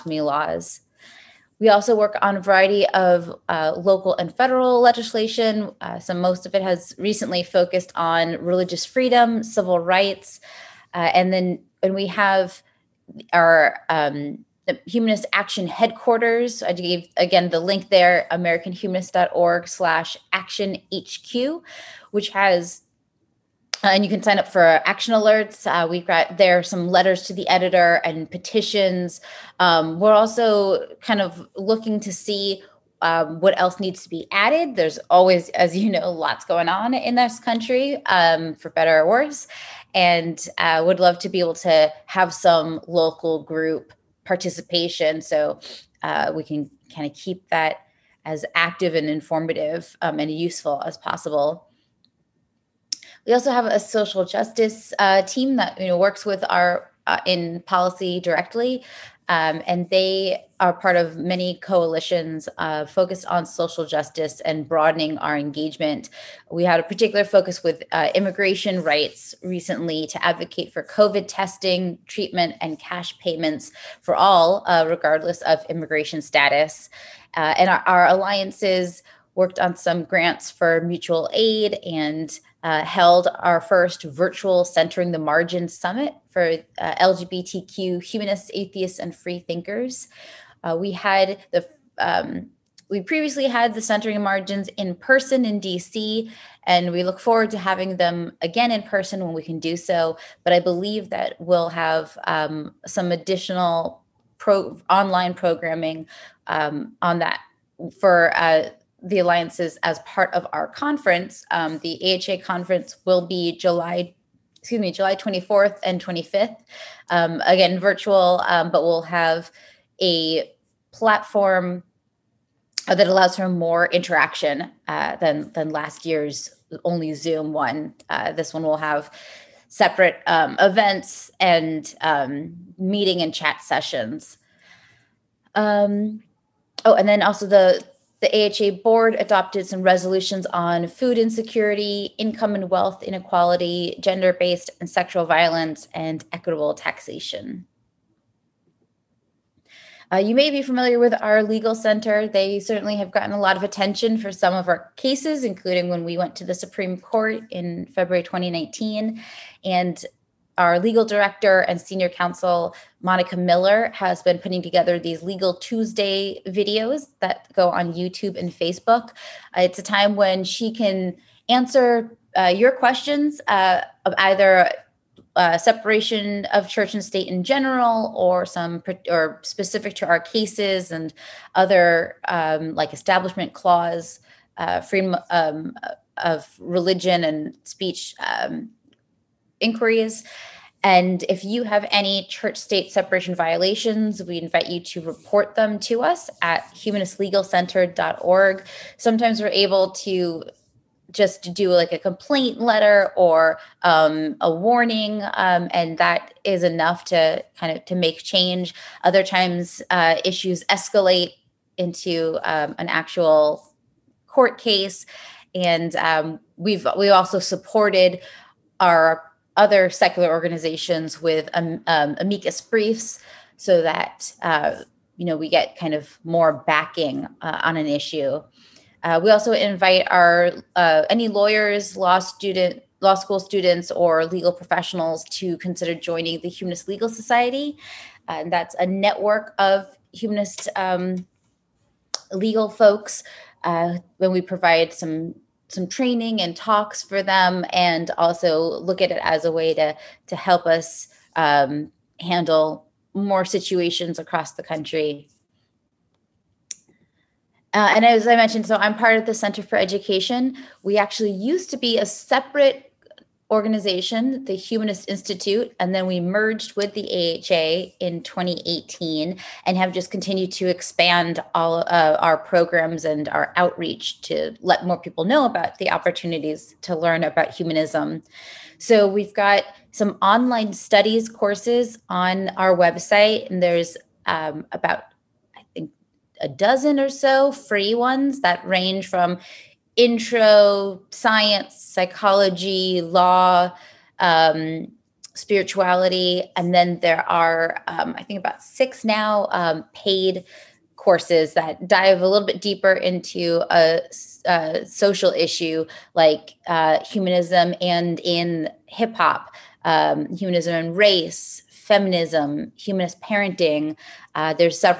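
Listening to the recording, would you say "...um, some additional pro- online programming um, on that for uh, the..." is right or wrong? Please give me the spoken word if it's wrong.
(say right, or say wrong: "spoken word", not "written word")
right.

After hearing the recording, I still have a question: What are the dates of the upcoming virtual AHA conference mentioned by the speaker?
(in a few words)
July 24th and 25th.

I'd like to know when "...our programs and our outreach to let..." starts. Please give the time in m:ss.
4:32.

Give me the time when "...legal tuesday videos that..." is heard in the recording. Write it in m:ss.
2:45.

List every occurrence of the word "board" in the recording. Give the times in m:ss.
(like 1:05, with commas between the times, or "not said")
2:18.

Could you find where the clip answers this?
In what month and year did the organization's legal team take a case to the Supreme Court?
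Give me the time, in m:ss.
2:37.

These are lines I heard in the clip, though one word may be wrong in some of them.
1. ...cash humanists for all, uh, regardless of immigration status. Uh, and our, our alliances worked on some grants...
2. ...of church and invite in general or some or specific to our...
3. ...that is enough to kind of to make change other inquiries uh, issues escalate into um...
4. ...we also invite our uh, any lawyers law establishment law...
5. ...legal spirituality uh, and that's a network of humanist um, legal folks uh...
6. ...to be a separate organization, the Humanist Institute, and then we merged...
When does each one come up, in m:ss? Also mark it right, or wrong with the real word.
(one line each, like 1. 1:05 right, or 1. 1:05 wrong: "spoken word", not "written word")
1. 1:12 wrong: "payments", not "humanists"
2. 2:56 wrong: "state", not "invite"
3. 3:25 wrong: "times", not "inquiries"
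4. 3:49 wrong: "student", not "establishment"
5. 3:56 wrong: "society", not "spirituality"
6. 4:21 right.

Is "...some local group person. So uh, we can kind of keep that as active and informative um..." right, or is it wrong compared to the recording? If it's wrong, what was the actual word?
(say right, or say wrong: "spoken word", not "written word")
wrong: "participation", not "person".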